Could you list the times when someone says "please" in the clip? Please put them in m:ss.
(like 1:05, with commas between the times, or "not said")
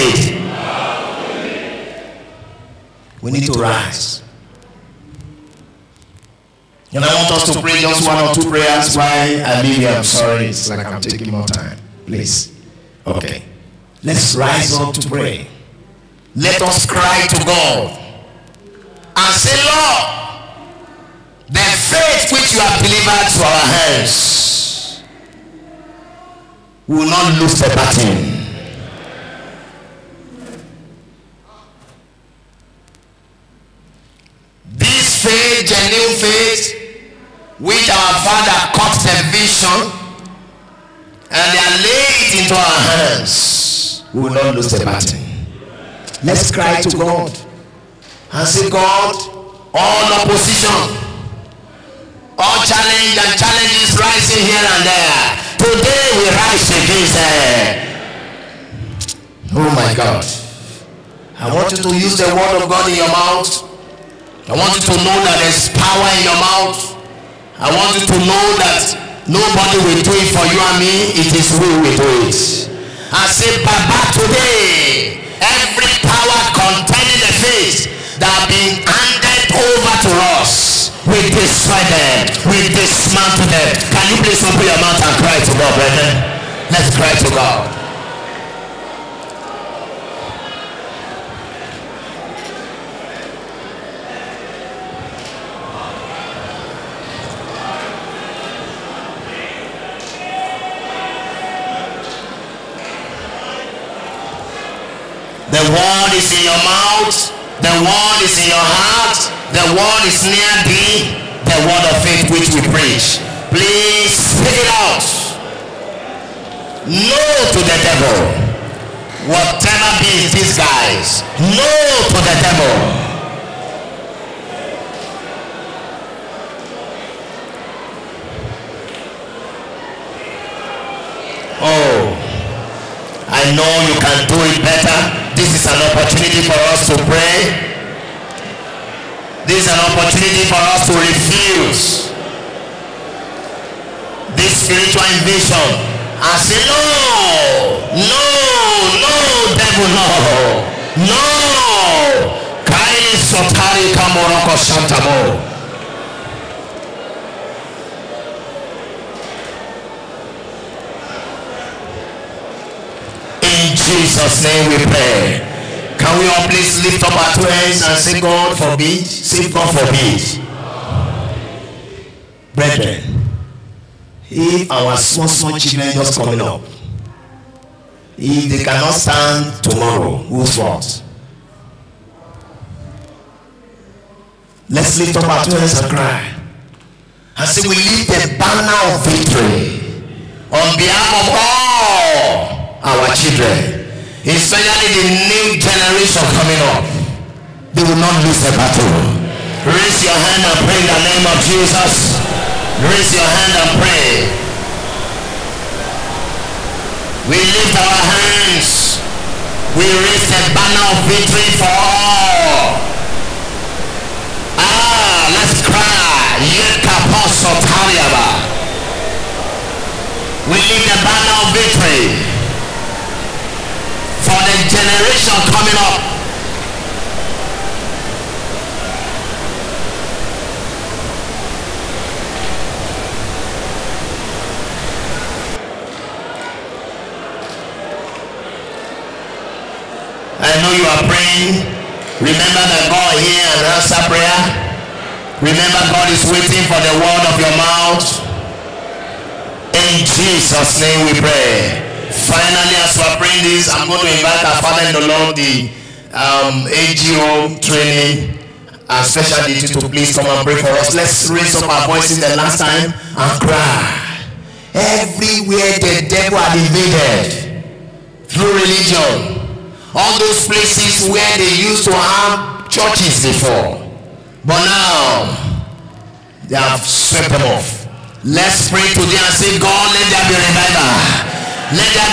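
0:12, 1:24, 1:53, 2:46, 4:19.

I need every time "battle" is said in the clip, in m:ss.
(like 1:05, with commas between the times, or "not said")
0:27, 0:44, 3:18.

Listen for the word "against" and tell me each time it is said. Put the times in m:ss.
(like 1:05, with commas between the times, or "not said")
0:56.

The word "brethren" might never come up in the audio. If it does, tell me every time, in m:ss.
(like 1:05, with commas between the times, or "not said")
1:25, 2:52.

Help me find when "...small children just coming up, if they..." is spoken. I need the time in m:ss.
2:55.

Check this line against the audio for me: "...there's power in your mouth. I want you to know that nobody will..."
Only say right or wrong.
right.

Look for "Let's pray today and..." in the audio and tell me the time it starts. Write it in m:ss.
4:38.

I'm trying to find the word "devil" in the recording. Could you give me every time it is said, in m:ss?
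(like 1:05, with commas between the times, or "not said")
1:57, 2:02, 2:29, 4:26.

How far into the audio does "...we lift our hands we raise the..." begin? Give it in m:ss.
3:27.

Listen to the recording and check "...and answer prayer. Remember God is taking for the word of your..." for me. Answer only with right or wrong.
wrong.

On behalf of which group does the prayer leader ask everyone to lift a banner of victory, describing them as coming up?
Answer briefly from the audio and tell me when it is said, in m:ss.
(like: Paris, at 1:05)
the new generation, at 3:14.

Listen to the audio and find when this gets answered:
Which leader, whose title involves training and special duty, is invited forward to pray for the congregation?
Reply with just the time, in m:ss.
4:16.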